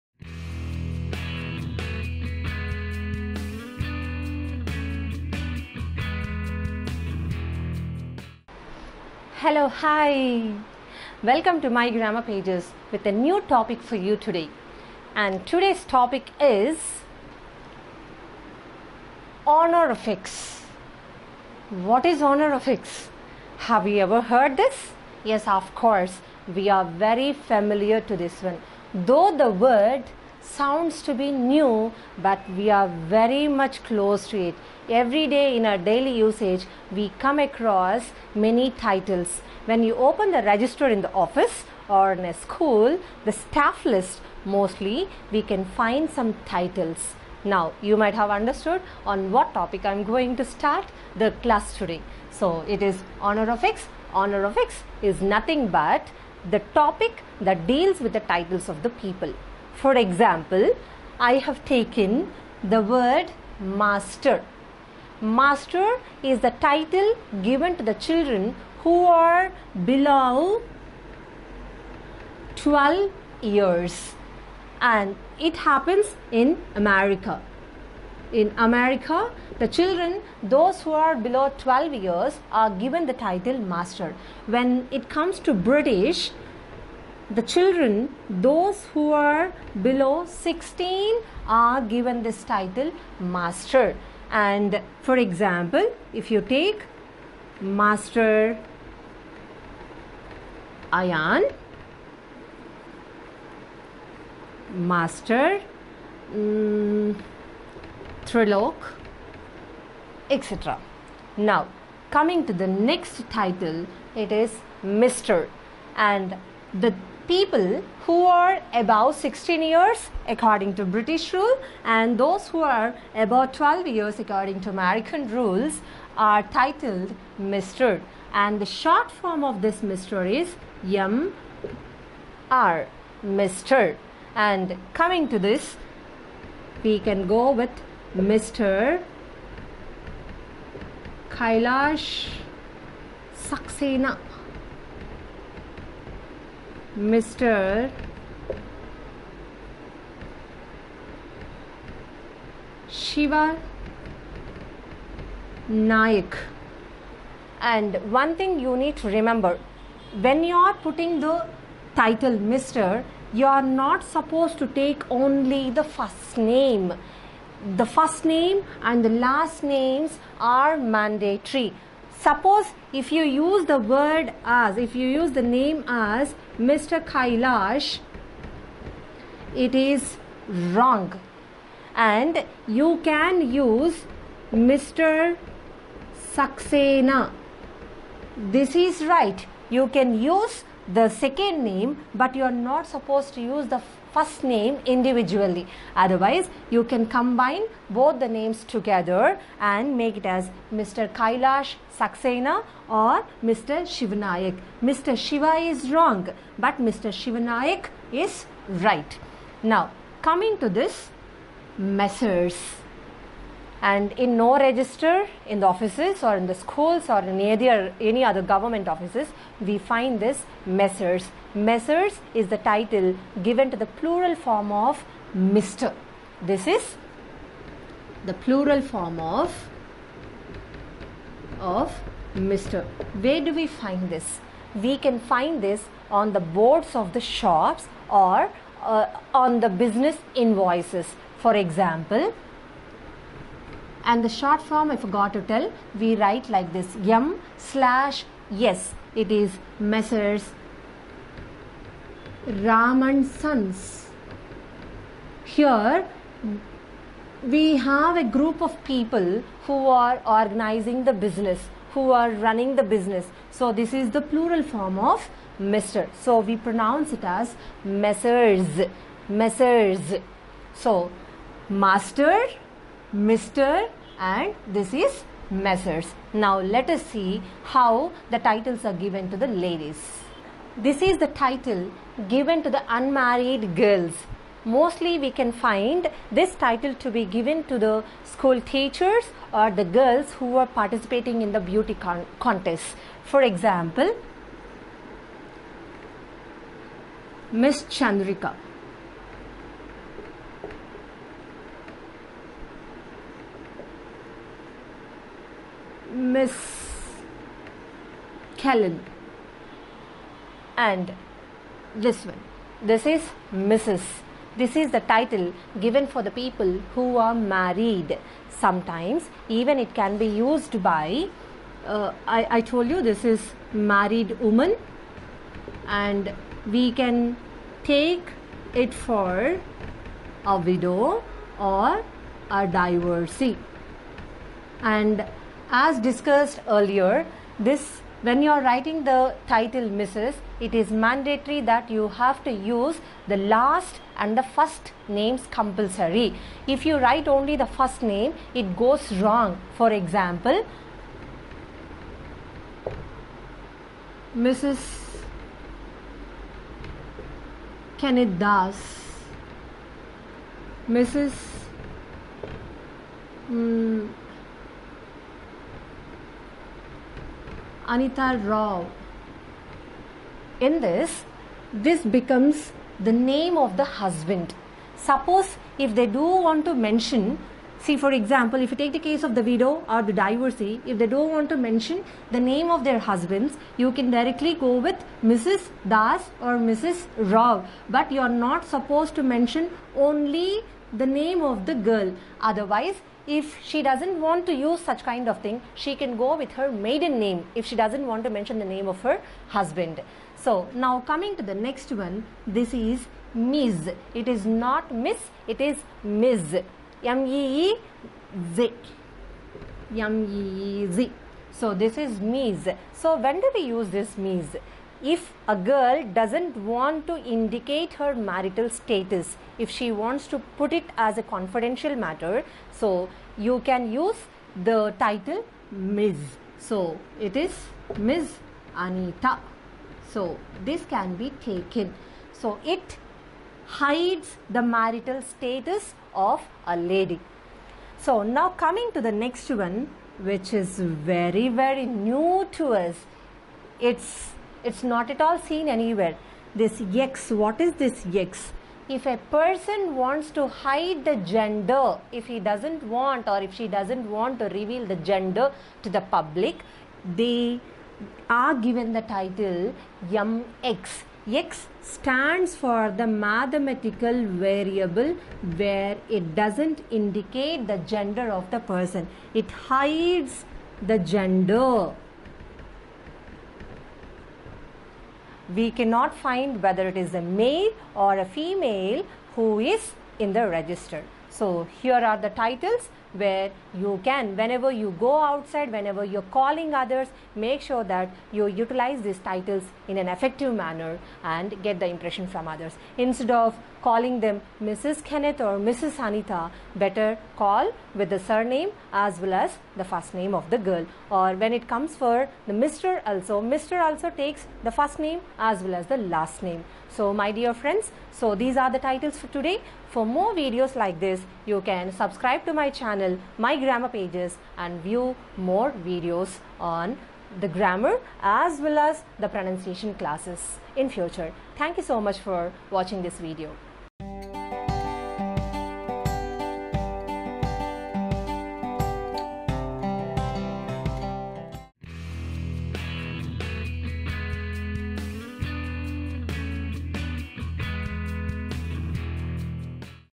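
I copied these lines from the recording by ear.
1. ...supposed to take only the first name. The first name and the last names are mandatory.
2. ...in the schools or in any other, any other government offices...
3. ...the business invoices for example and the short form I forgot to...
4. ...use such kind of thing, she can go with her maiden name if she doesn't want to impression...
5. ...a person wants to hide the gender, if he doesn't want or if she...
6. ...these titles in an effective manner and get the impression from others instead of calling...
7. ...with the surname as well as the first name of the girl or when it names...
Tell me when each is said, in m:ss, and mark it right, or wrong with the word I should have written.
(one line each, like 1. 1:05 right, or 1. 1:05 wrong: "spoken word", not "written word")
1. 2:44 right
2. 3:36 right
3. 3:59 right
4. 6:34 wrong: "mention", not "impression"
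5. 7:29 right
6. 8:09 right
7. 8:17 wrong: "comes", not "names".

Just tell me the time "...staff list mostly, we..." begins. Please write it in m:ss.
0:43.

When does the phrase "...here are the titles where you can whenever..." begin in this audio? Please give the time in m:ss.
8:01.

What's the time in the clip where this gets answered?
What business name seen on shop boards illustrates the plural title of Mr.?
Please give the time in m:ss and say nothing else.
4:12.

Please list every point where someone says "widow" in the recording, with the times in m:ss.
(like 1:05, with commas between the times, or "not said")
5:30, 6:19.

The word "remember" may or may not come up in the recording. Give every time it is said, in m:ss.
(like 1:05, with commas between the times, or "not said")
2:39.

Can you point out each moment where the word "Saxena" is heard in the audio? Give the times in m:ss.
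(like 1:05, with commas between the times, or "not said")
2:23, 3:06, 3:21.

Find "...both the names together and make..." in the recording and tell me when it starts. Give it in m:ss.
3:17.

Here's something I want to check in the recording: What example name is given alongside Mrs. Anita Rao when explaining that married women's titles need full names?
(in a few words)
Mrs. Kenneth Das.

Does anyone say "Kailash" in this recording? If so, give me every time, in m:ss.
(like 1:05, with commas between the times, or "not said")
2:21, 2:57, 3:21.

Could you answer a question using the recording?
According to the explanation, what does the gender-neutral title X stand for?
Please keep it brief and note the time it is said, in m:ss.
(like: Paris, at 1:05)
mathematical variable, at 7:43.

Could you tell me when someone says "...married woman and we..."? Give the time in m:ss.
5:23.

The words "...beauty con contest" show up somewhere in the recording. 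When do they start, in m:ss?
4:51.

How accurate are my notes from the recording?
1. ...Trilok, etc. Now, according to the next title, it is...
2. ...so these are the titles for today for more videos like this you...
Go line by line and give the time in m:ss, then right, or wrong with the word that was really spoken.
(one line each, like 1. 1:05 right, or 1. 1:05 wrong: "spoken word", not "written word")
1. 1:48 wrong: "coming", not "according"
2. 8:28 right.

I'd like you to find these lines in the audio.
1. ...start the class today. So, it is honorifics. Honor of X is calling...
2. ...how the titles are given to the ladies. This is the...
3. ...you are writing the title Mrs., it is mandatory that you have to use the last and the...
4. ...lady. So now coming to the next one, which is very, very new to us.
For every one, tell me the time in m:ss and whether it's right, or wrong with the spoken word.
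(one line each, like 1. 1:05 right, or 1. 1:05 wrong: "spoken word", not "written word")
1. 0:50 wrong: "nothing", not "calling"
2. 4:37 right
3. 5:38 right
4. 7:16 right.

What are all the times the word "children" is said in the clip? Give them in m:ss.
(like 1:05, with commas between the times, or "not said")
1:07, 1:19, 1:27.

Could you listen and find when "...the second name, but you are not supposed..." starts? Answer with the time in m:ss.
3:10.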